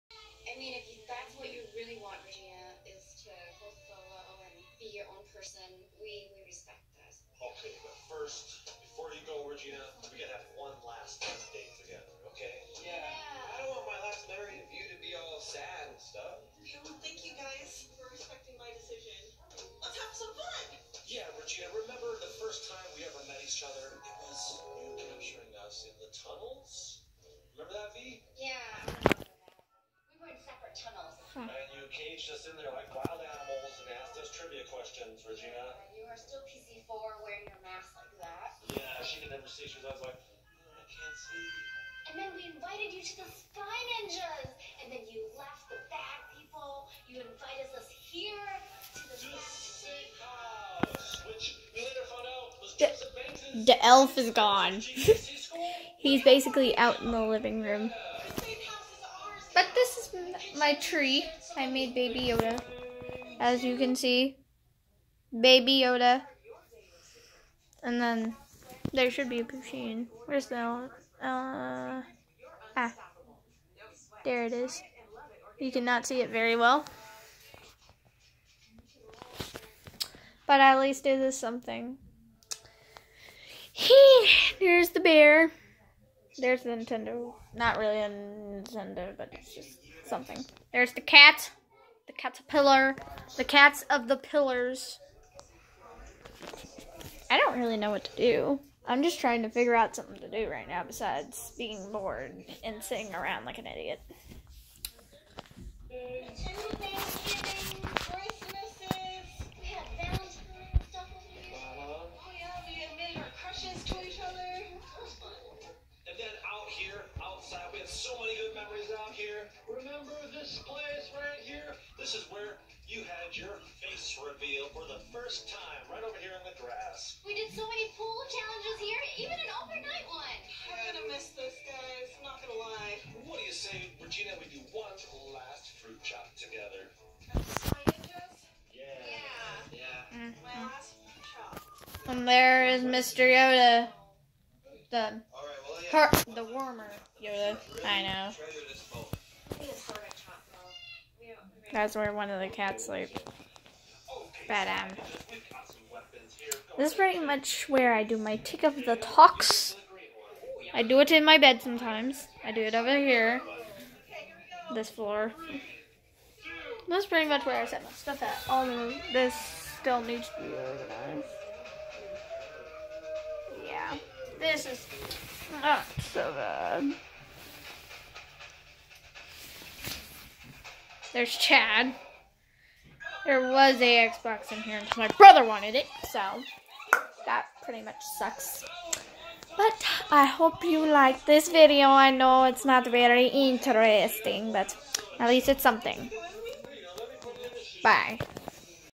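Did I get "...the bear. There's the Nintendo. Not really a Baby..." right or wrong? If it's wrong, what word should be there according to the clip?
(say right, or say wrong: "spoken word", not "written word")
wrong: "Nintendo", not "Baby".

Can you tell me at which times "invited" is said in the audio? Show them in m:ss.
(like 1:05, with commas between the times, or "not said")
0:42, 0:47.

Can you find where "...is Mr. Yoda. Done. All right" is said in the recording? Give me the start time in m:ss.
2:22.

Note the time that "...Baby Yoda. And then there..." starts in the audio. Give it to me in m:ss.
1:05.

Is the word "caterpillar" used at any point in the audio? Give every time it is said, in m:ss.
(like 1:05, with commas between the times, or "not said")
1:32.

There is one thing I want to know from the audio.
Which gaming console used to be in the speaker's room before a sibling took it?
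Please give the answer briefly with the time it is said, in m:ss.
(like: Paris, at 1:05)
Xbox, at 3:04.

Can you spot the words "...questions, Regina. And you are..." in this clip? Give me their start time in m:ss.
0:34.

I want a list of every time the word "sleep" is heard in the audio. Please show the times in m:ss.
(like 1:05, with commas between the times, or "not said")
2:32.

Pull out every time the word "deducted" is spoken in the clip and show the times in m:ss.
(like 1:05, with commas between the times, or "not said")
not said.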